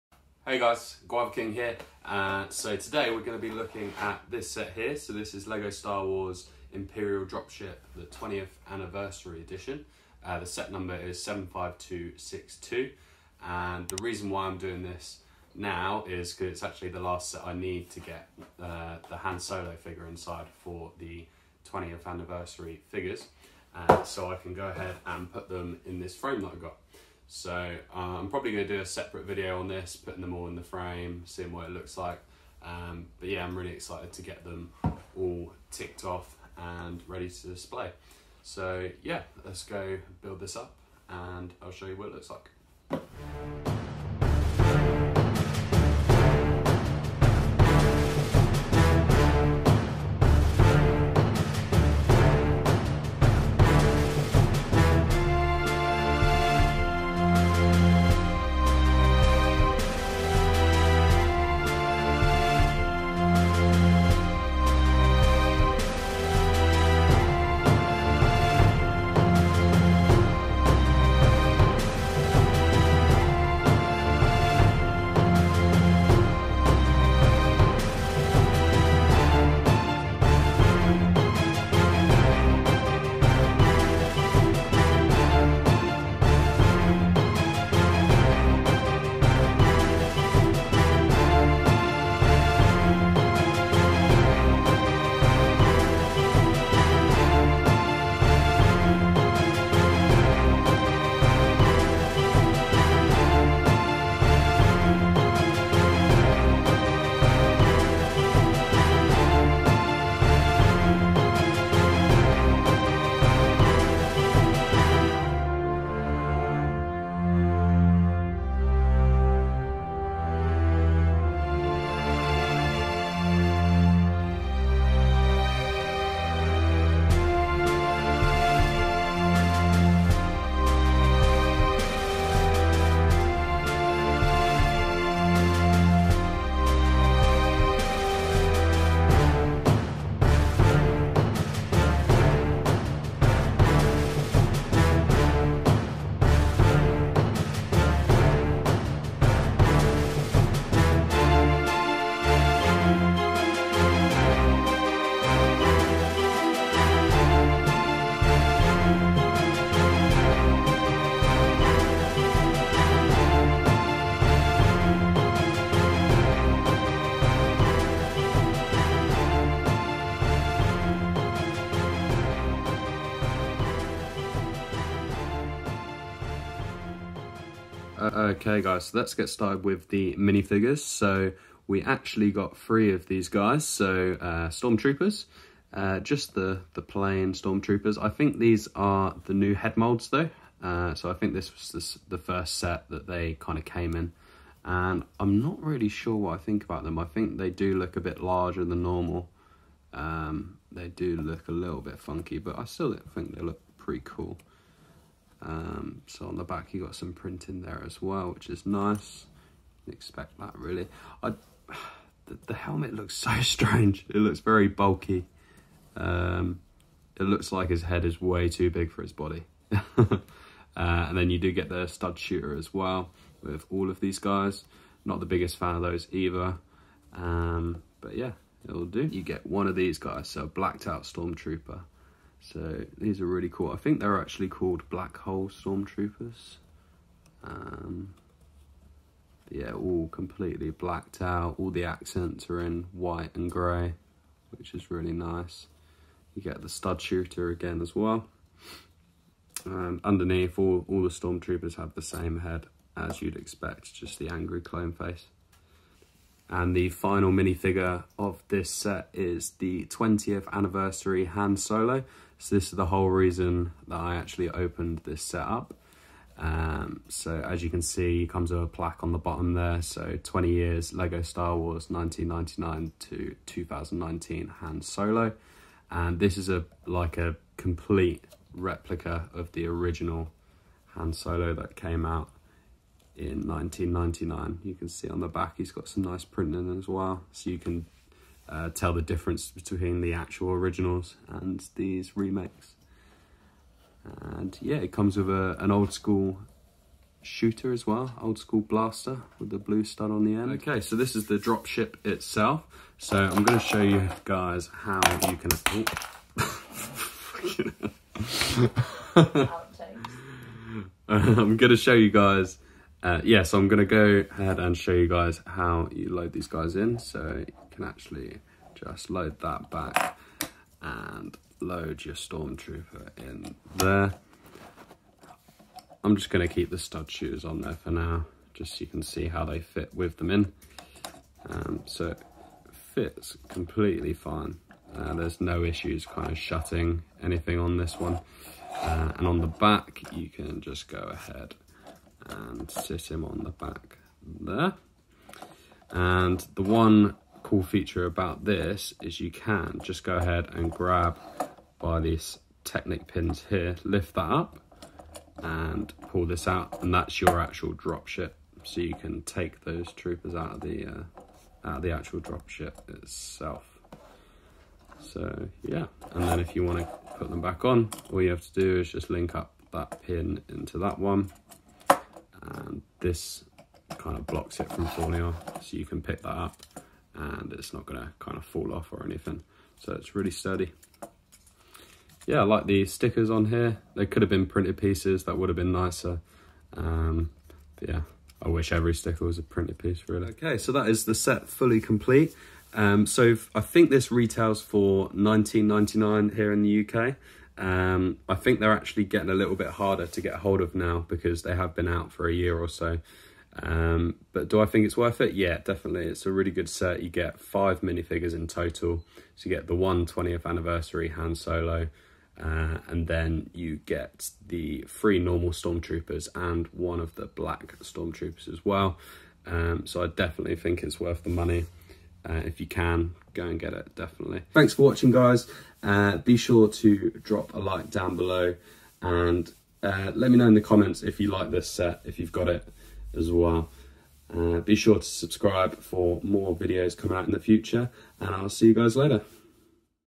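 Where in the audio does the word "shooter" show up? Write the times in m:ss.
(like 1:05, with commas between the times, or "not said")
3:42, 4:07, 4:57.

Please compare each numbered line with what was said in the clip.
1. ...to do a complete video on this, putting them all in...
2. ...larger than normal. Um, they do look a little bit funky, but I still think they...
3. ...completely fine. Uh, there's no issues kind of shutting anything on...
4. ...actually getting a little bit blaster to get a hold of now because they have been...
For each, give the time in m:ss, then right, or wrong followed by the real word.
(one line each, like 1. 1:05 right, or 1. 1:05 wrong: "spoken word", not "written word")
1. 0:28 wrong: "separate", not "complete"
2. 3:18 right
3. 5:33 right
4. 6:38 wrong: "harder", not "blaster".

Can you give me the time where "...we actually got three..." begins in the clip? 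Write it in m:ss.
3:01.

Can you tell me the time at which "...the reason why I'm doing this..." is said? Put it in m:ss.
0:13.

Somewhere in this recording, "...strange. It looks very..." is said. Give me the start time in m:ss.
3:33.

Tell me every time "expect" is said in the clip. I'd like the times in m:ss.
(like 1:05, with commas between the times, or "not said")
3:29, 4:13.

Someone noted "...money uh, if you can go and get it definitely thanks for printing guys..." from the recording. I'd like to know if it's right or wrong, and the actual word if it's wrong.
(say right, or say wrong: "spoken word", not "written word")
wrong: "watching", not "printing".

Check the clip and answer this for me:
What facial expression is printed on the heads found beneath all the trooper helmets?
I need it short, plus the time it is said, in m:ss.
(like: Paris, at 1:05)
angry clone face, at 4:14.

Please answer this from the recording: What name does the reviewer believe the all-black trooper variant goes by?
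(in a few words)
Black Hole Stormtroopers.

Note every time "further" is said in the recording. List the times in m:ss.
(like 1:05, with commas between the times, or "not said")
not said.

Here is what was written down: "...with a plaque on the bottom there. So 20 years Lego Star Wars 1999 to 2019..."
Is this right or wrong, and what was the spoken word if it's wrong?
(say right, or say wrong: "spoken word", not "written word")
right.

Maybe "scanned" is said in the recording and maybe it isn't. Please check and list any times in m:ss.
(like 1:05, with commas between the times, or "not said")
not said.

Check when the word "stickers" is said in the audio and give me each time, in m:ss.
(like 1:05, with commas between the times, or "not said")
6:22, 6:28.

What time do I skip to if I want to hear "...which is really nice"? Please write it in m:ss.
4:04.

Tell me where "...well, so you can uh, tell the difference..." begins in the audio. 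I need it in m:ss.
4:46.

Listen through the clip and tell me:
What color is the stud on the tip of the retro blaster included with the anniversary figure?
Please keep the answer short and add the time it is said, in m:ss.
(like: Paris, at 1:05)
blue, at 4:59.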